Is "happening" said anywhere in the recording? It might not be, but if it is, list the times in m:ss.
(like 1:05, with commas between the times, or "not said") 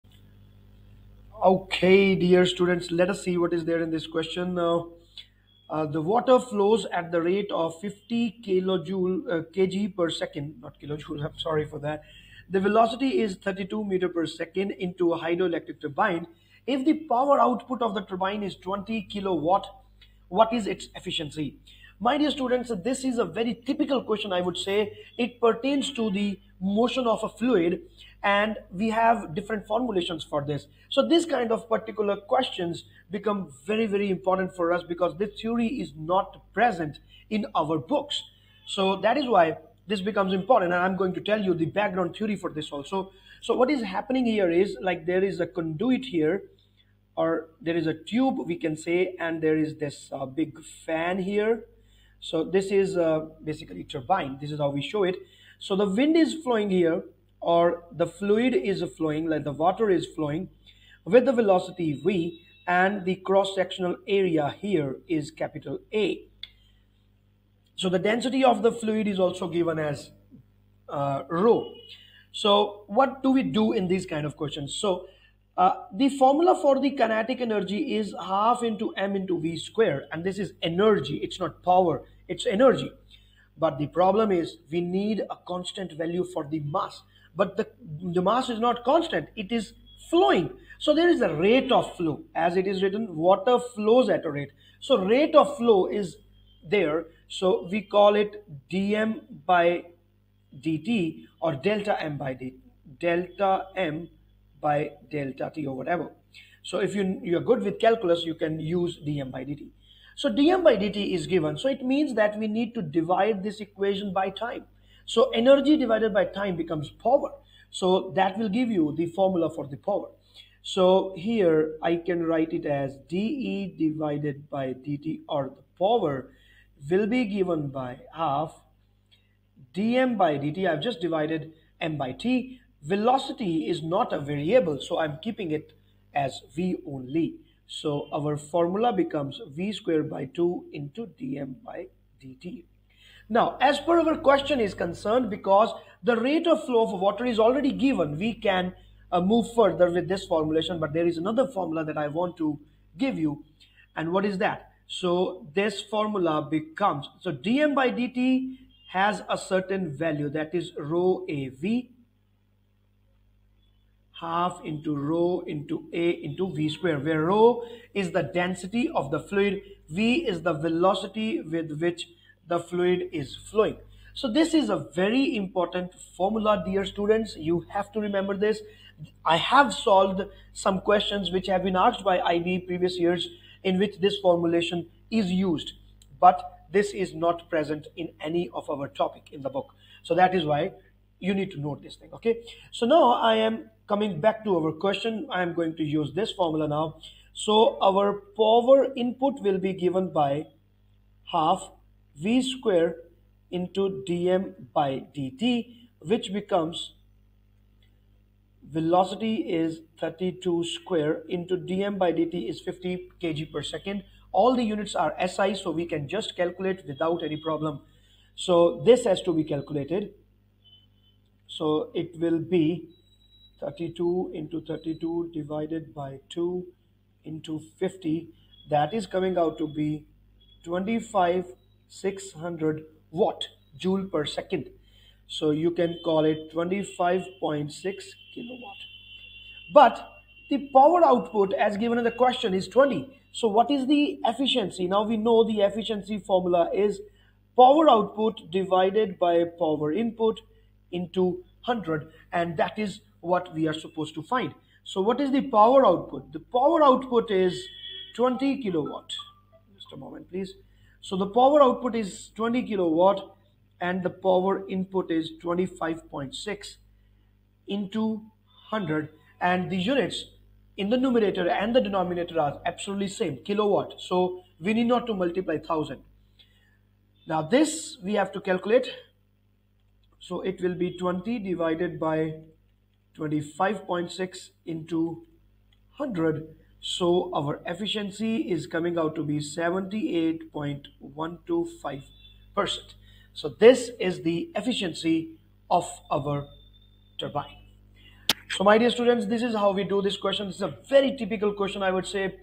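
0:43.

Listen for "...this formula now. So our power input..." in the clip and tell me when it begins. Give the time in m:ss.
3:16.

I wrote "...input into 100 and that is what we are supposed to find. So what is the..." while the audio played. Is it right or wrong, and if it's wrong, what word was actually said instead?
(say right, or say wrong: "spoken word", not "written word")
right.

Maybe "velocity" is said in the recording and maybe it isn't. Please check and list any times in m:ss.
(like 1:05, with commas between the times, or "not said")
0:12, 1:01, 2:12, 2:50, 3:28.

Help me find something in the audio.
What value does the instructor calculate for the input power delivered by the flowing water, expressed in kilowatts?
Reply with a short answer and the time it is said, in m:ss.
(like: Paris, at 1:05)
25.6 kilowatts, at 3:56.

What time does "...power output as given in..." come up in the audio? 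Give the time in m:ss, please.
4:00.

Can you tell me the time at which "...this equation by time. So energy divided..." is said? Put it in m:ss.
1:53.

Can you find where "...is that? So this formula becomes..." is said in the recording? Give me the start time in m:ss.
2:34.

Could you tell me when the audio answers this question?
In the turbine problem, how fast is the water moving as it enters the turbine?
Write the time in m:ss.
0:13.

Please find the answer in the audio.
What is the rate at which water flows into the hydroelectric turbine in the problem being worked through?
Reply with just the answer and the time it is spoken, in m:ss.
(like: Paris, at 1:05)
50 kg per second, at 0:07.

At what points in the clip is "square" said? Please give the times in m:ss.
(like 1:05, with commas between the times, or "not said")
1:19, 2:19, 2:46, 3:22, 3:30.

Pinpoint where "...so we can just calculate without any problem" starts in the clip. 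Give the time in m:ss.
3:35.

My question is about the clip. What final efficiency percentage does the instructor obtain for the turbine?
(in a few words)
78.125%.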